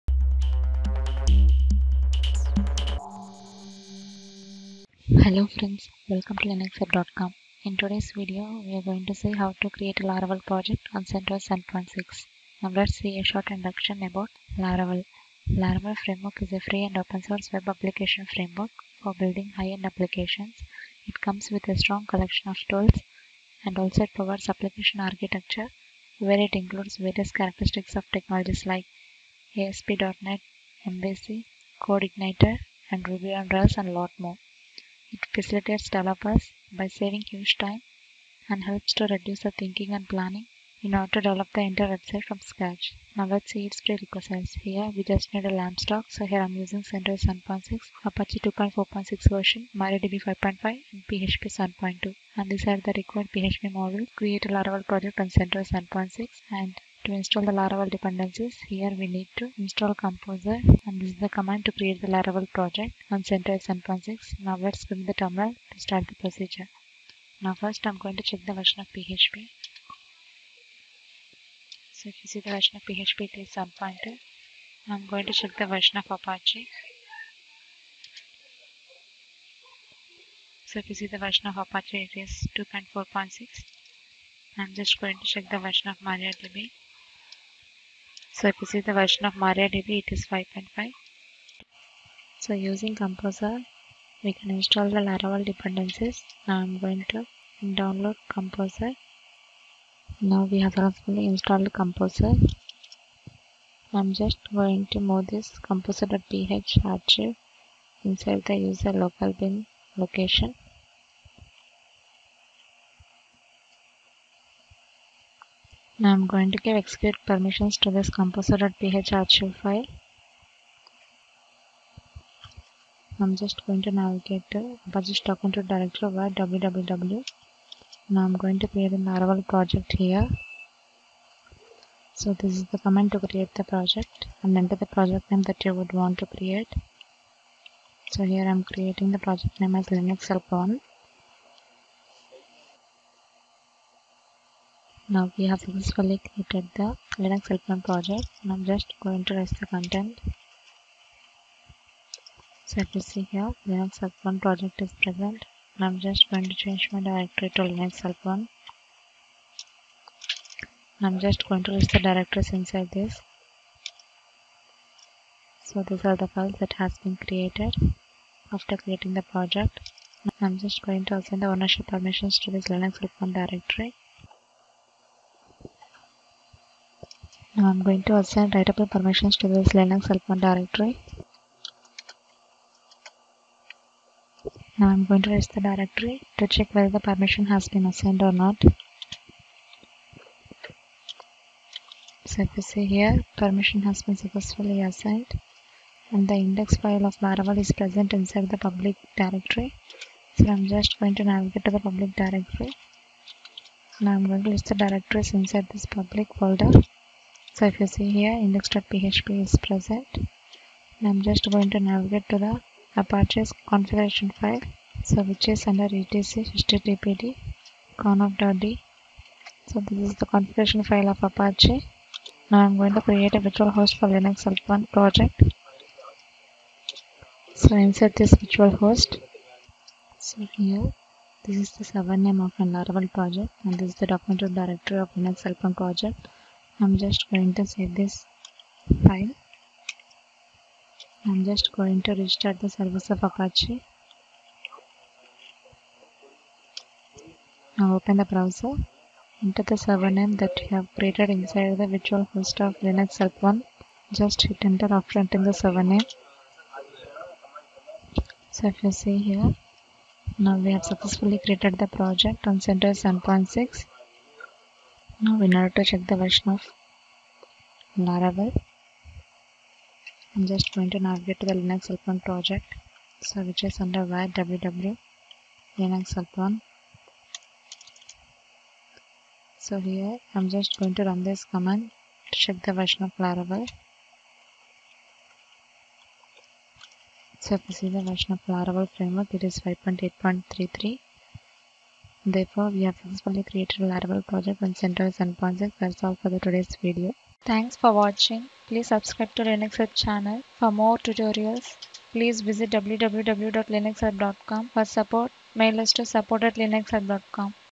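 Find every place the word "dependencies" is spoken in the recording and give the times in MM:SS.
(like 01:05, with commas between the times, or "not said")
00:57, 01:35.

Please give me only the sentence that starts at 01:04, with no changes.
Now let's go the terminal to start the procedure.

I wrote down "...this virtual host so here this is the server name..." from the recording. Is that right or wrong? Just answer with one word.
right.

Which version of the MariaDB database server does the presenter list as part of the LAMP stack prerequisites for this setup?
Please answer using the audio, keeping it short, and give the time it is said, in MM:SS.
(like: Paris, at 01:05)
5.5, at 00:49.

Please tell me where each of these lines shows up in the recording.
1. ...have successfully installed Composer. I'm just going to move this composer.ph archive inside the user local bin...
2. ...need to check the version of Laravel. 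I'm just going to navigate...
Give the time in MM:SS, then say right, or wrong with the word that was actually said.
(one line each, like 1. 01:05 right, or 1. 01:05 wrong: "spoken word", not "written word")
1. 01:40 right
2. 04:25 right.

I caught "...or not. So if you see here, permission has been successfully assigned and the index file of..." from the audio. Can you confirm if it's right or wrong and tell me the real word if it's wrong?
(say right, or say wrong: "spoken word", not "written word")
right.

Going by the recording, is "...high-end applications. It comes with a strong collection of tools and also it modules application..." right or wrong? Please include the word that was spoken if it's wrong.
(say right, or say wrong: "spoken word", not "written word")
wrong: "provides", not "modules".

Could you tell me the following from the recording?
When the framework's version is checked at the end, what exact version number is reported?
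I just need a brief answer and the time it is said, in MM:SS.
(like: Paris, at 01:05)
5.8.33, at 04:49.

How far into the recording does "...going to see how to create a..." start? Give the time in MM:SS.
00:08.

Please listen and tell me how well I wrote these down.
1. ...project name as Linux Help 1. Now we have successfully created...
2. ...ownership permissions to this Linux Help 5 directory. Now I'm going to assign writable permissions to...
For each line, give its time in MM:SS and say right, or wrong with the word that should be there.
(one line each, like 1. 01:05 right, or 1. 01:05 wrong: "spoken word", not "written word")
1. 02:19 right
2. 02:51 wrong: "1", not "5".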